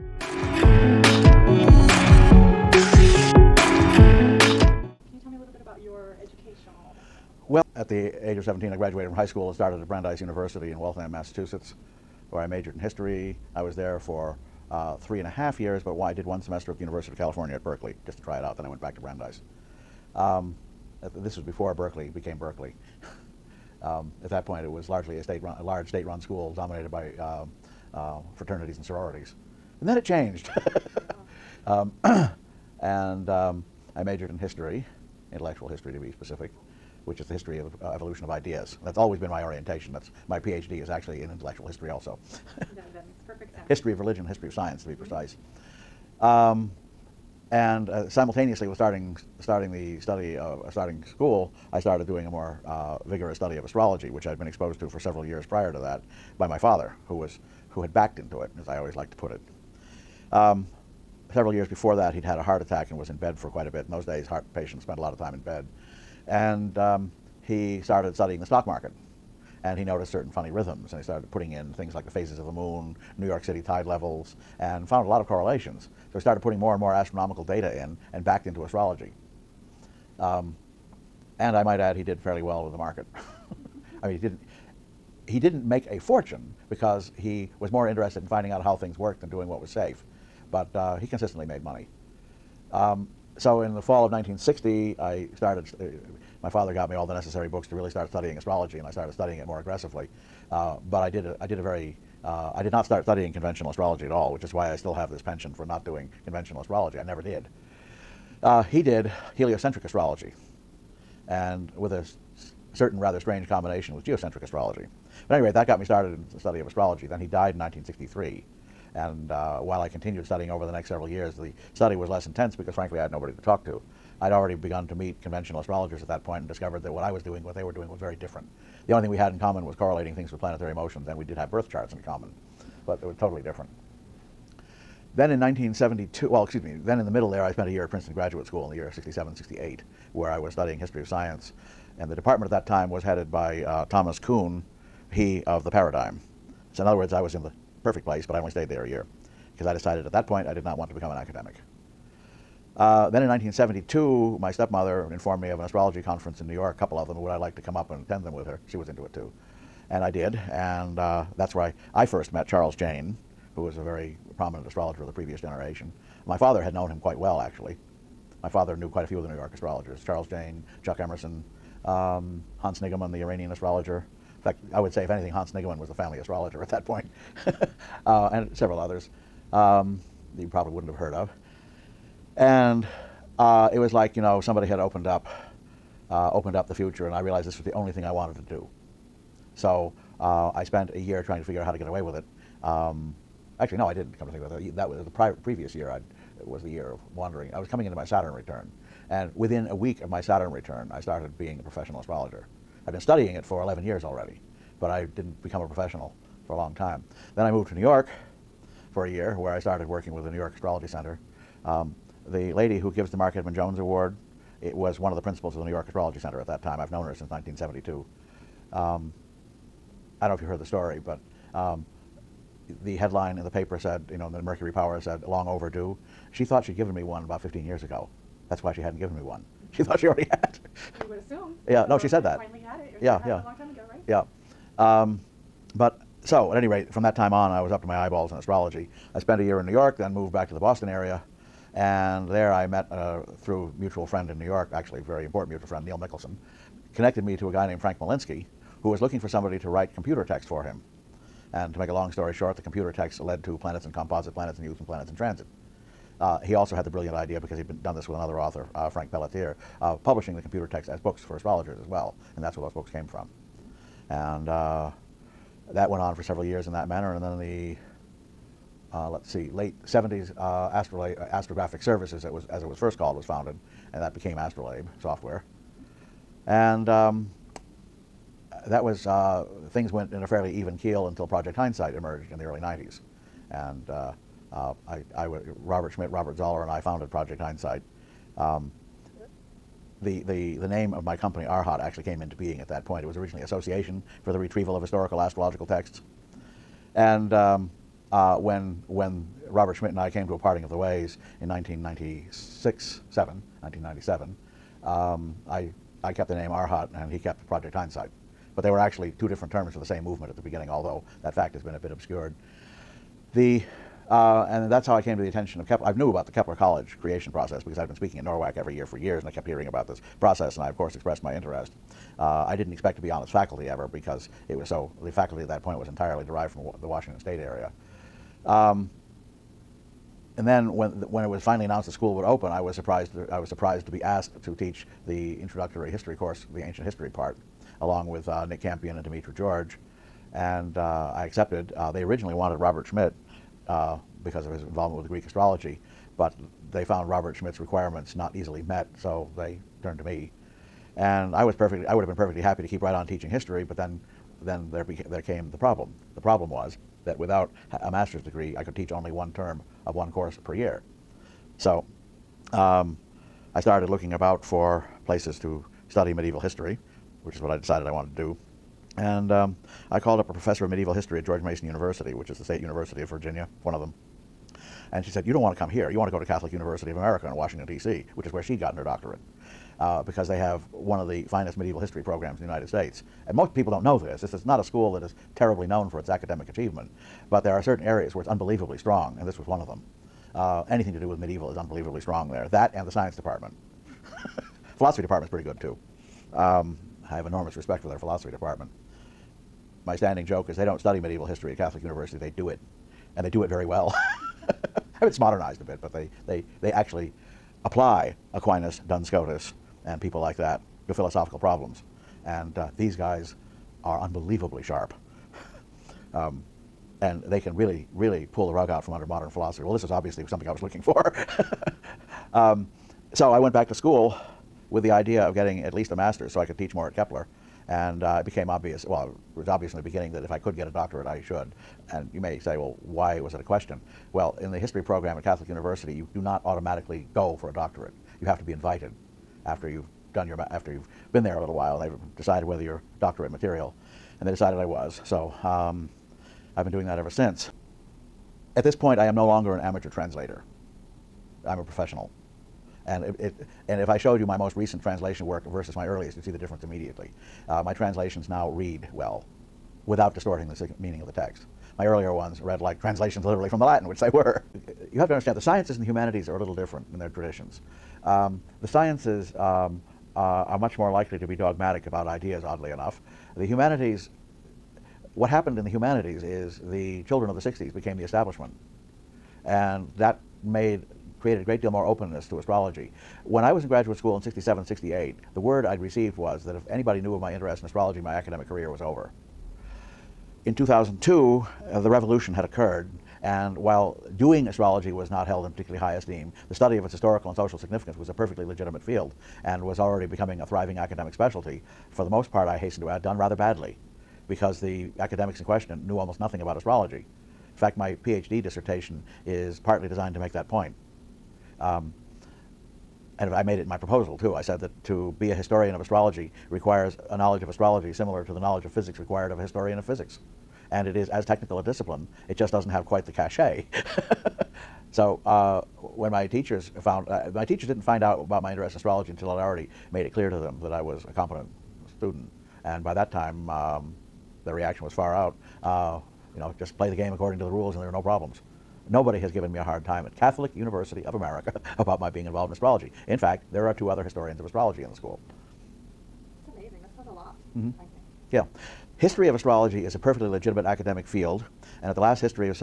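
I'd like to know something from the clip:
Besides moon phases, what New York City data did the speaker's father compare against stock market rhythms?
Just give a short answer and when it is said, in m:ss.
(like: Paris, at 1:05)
Tide levels, at 1:13.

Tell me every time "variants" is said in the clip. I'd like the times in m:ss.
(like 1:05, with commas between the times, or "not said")
not said.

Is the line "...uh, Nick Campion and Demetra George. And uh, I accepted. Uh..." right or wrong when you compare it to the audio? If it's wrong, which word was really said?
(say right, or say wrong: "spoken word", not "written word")
right.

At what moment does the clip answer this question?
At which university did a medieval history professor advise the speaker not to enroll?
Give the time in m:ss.
6:11.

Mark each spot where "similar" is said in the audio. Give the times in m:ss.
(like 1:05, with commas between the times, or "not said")
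8:37.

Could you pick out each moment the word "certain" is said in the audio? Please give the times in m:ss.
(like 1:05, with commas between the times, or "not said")
1:10, 1:52, 6:27.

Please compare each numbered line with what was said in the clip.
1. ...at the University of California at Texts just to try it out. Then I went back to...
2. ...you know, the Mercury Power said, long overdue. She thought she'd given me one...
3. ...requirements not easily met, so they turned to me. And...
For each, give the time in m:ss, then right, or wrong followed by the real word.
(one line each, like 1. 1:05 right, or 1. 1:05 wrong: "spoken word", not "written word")
1. 0:16 wrong: "Berkeley", not "Texts"
2. 3:44 right
3. 5:47 right.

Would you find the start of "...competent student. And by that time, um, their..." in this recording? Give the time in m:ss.
8:51.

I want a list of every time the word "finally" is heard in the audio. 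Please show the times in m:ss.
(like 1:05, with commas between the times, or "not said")
3:52, 5:31.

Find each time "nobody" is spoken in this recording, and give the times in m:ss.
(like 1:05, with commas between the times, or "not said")
2:03, 8:58.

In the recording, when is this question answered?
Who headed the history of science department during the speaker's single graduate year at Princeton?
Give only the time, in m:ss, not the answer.
2:23.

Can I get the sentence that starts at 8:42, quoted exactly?
It just doesn't have quite the cachet.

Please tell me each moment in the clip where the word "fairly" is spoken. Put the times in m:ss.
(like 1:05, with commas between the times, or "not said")
1:22, 4:40.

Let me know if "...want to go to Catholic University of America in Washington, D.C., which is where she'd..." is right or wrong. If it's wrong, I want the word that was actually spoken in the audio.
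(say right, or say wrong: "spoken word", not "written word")
right.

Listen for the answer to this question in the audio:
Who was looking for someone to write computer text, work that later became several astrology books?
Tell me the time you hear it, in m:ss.
4:07.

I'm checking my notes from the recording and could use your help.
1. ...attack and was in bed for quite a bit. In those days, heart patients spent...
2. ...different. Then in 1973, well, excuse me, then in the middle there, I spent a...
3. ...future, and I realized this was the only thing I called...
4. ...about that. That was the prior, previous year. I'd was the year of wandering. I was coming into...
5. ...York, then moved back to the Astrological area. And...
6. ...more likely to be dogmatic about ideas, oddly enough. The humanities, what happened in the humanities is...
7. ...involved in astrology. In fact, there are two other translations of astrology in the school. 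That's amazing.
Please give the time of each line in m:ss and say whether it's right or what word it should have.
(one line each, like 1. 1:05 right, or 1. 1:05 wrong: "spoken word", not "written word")
1. 1:02 right
2. 2:13 wrong: "1972", not "1973"
3. 3:06 wrong: "wanted", not "called"
4. 3:14 right
5. 3:59 wrong: "Boston", not "Astrological"
6. 7:50 right
7. 9:02 wrong: "historians", not "translations".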